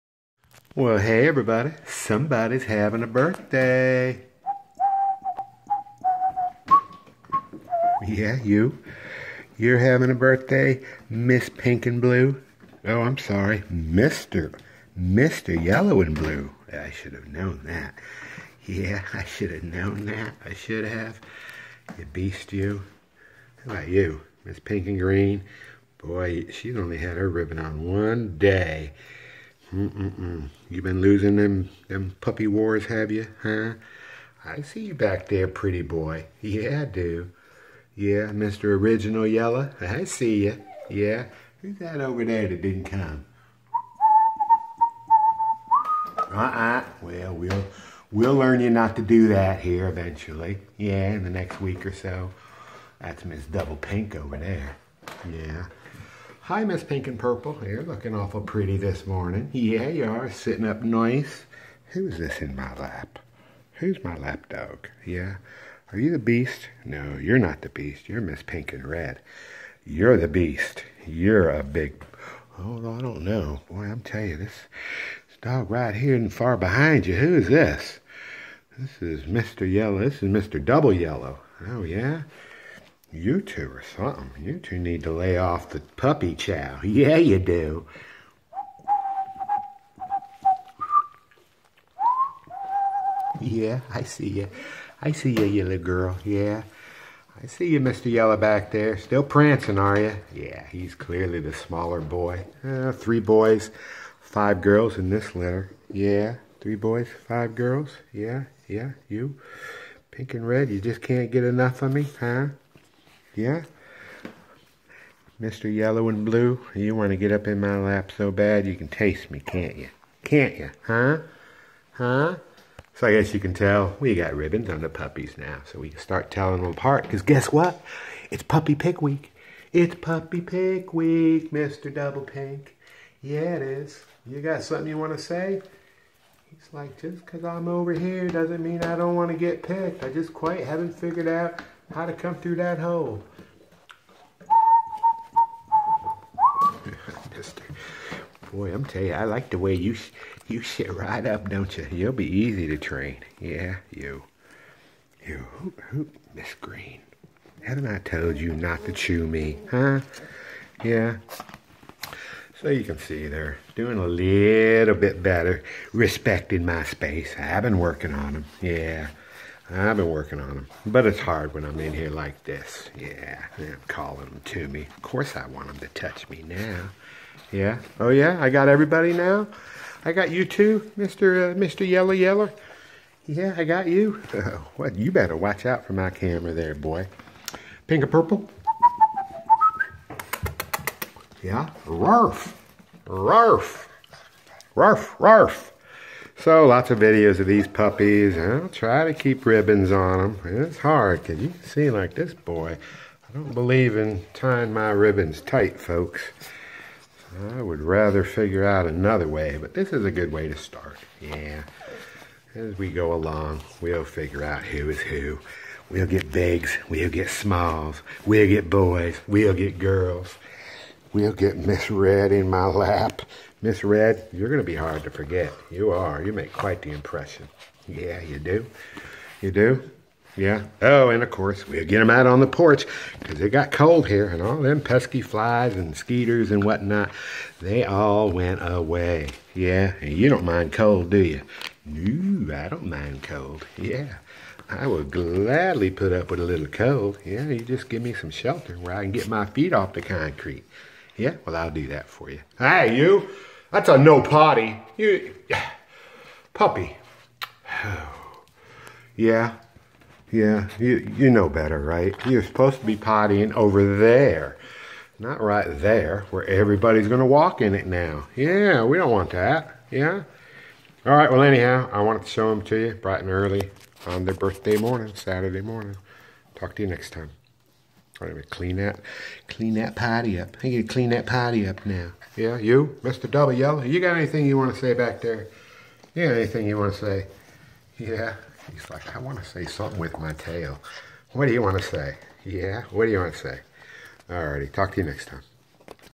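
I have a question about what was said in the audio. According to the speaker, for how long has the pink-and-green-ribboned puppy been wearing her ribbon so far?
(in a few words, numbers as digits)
one day.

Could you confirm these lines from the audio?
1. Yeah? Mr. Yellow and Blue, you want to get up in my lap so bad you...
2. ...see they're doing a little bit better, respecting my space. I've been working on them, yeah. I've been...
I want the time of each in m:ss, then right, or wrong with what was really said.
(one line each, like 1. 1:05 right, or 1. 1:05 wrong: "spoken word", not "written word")
1. 1:53 right
2. 2:42 right.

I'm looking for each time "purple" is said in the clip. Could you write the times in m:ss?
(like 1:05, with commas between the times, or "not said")
0:57, 3:08.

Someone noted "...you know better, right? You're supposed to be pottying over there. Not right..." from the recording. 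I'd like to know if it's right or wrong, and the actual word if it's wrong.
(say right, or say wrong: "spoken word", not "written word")
right.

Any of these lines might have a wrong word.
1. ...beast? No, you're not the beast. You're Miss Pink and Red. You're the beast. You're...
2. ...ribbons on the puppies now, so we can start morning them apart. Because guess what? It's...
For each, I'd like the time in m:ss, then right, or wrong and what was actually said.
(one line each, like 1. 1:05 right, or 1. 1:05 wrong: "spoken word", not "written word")
1. 1:06 right
2. 2:04 wrong: "telling", not "morning".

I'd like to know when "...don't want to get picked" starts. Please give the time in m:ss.
2:18.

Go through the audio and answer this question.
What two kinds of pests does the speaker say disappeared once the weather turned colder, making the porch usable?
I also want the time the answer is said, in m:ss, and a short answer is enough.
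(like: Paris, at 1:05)
flies and skeeters, at 3:55.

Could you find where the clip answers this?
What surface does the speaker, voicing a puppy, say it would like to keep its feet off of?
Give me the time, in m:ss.
4:09.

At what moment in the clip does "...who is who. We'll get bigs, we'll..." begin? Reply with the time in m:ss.
3:34.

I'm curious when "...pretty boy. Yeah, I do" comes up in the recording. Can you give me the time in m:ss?
0:35.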